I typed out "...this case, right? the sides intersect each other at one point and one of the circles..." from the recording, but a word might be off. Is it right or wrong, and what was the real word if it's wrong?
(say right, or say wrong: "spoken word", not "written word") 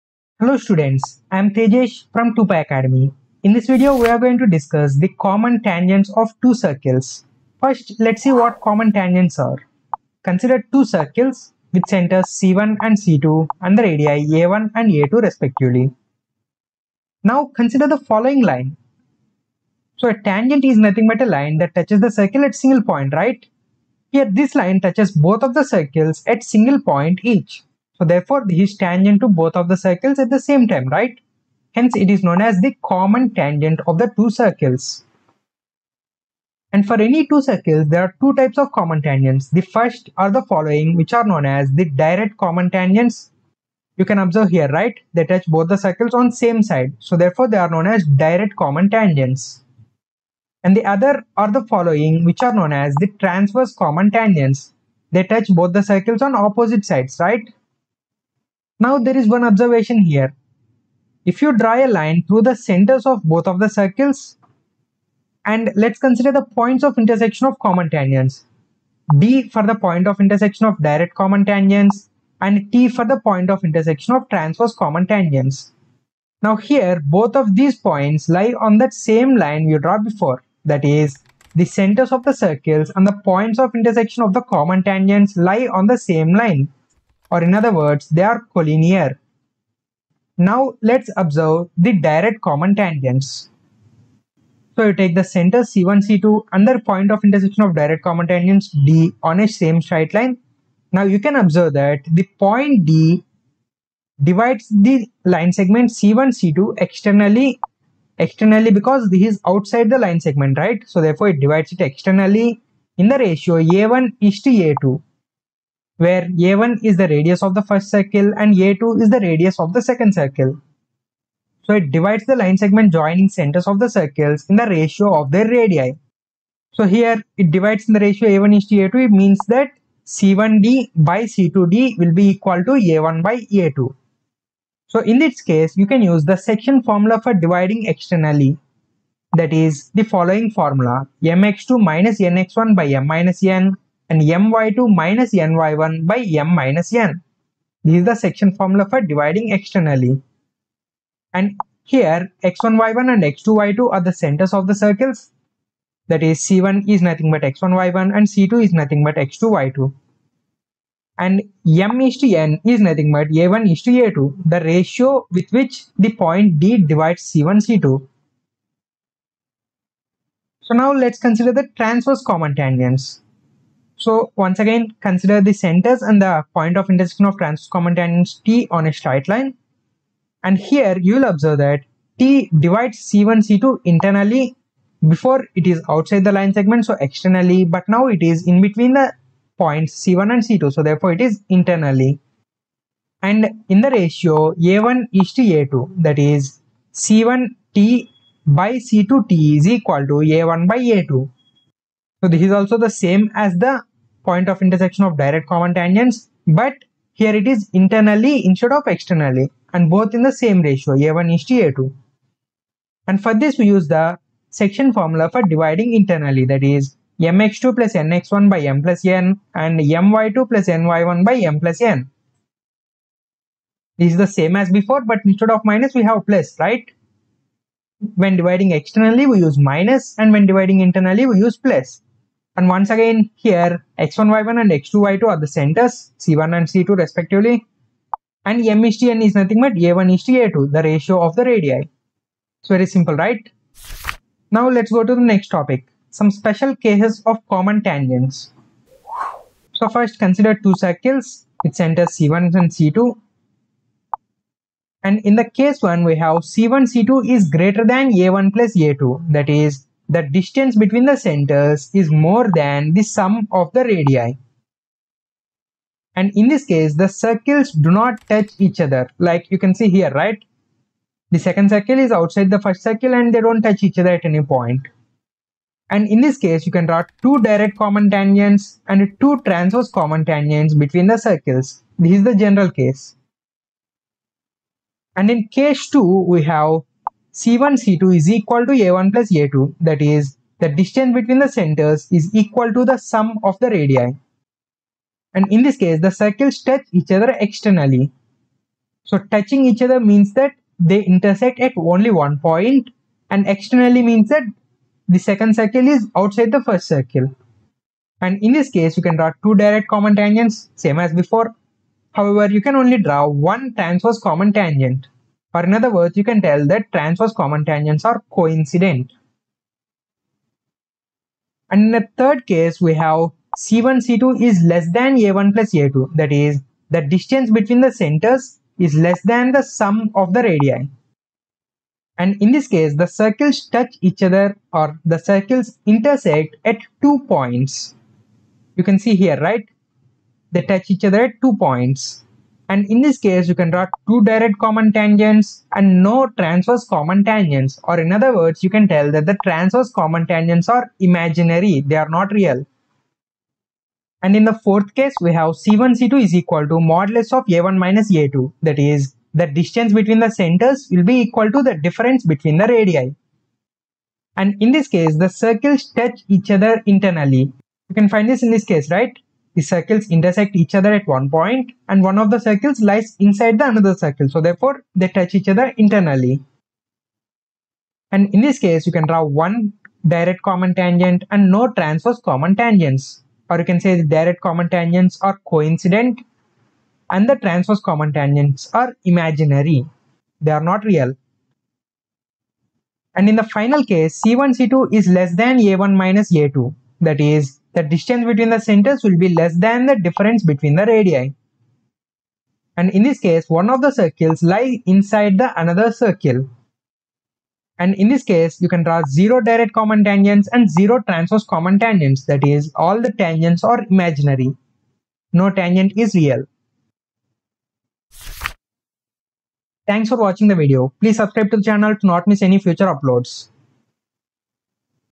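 wrong: "circles", not "sides".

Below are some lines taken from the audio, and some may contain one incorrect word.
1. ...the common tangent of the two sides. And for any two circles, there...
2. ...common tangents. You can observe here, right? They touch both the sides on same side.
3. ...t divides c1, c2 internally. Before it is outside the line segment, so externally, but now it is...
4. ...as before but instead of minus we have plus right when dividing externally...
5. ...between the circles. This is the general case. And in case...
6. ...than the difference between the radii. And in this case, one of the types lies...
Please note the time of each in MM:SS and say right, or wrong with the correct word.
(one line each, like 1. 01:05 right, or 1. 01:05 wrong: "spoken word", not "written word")
1. 00:32 wrong: "circles", not "sides"
2. 00:42 wrong: "circles", not "sides"
3. 03:02 right
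4. 03:44 right
5. 04:40 right
6. 06:39 wrong: "circles", not "types".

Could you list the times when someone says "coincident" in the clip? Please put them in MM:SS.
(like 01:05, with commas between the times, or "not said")
05:18, 06:25.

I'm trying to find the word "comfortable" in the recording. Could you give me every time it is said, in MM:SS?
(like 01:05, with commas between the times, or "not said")
not said.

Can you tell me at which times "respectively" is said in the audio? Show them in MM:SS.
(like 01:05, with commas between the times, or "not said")
00:15, 03:56.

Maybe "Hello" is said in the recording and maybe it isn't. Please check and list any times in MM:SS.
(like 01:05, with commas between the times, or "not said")
00:00.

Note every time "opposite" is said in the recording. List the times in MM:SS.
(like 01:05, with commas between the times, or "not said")
00:56.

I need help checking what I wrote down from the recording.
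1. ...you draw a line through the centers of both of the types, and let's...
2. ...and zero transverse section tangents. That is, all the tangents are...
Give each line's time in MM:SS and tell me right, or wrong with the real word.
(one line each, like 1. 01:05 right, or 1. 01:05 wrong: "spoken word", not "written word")
1. 01:01 wrong: "circles", not "types"
2. 06:50 wrong: "common", not "section".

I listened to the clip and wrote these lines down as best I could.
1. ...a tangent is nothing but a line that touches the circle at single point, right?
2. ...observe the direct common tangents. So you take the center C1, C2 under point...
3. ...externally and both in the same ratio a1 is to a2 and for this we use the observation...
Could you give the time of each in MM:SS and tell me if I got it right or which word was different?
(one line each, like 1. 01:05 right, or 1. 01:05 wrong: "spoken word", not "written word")
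1. 00:20 right
2. 01:31 right
3. 03:28 wrong: "section", not "observation".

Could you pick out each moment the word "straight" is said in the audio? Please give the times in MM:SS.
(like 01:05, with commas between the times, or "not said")
01:39, 02:58.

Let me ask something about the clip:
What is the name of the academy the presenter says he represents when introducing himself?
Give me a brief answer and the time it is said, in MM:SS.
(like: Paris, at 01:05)
2Pi Academy, at 00:02.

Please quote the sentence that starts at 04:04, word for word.
Now let's go to the next topic some special cases of common tangents.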